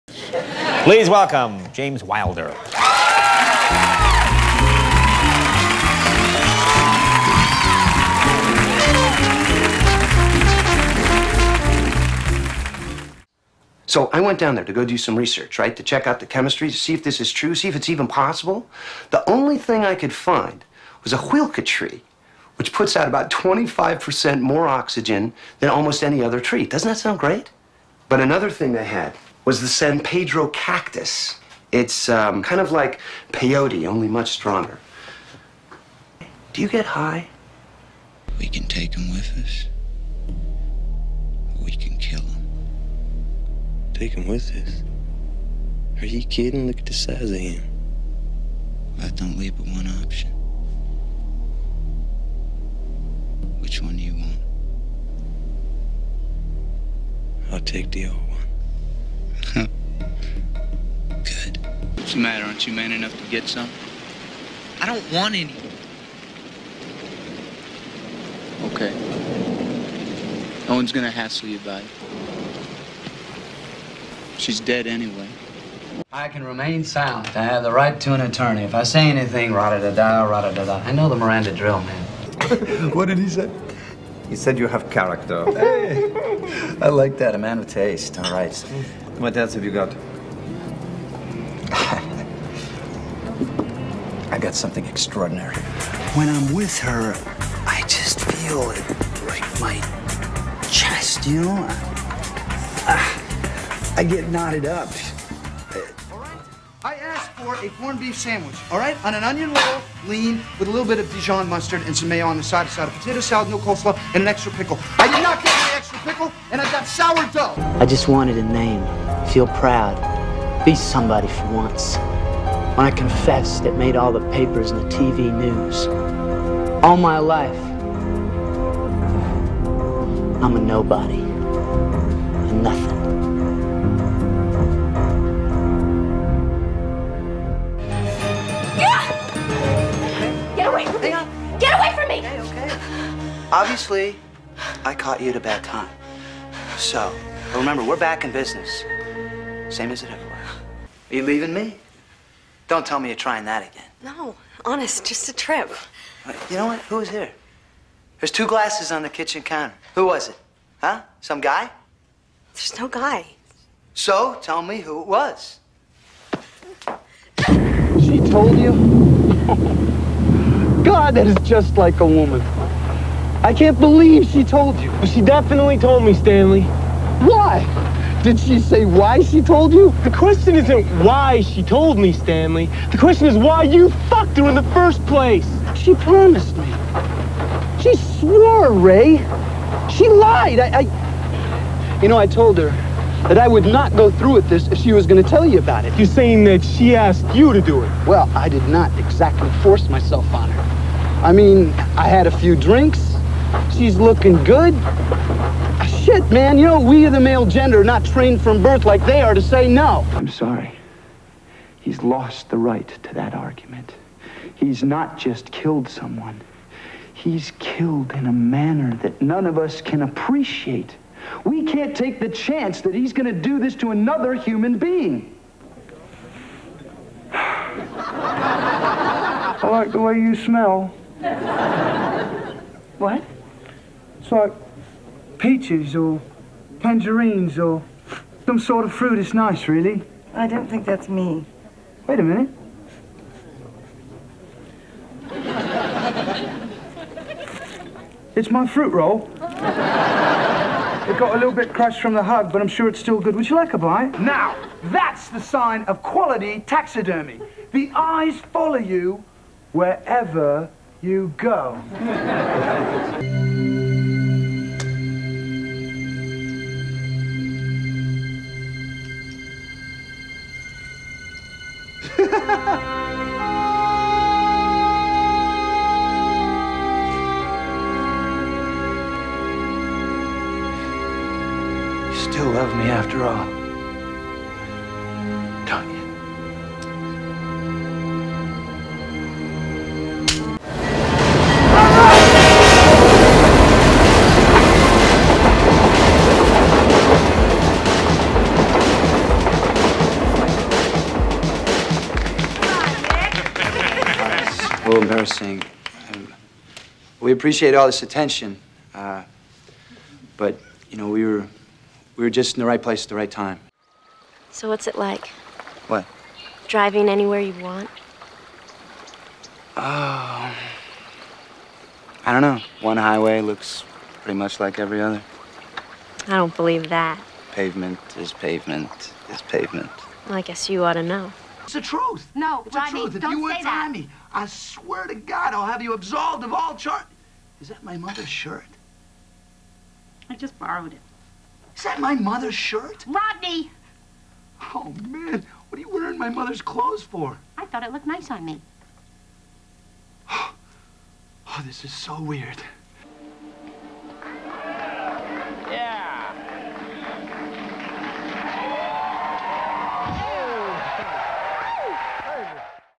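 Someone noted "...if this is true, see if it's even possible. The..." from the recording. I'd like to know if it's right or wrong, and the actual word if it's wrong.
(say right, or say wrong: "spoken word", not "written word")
right.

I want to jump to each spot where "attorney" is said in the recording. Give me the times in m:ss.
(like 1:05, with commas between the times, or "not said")
1:18.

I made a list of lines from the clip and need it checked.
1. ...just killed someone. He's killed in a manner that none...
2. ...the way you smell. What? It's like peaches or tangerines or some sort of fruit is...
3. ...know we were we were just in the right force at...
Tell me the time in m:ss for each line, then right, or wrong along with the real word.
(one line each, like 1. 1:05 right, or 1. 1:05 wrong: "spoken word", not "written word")
1. 3:35 right
2. 3:49 right
3. 5:10 wrong: "place", not "force".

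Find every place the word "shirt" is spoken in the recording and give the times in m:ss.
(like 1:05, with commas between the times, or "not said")
5:38, 5:42.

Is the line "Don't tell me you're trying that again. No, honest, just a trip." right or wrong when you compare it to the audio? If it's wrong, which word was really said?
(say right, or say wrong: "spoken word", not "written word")
right.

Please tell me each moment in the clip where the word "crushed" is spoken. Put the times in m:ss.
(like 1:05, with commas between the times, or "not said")
4:11.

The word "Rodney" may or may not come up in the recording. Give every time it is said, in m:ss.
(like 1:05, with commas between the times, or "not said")
5:32, 5:43.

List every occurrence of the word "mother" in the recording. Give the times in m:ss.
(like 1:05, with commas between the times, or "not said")
5:37, 5:42, 5:46.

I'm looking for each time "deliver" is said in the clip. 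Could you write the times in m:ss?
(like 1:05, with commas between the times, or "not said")
not said.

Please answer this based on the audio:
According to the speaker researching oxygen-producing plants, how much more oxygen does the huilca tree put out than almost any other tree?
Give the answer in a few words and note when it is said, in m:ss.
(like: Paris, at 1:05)
25%, at 0:23.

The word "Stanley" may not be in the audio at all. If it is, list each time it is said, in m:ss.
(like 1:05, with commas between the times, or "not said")
2:56, 3:02.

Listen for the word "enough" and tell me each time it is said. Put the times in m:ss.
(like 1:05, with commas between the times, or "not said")
1:02.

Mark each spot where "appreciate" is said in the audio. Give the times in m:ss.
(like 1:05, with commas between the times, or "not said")
3:40, 5:07.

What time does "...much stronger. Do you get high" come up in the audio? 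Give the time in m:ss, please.
0:34.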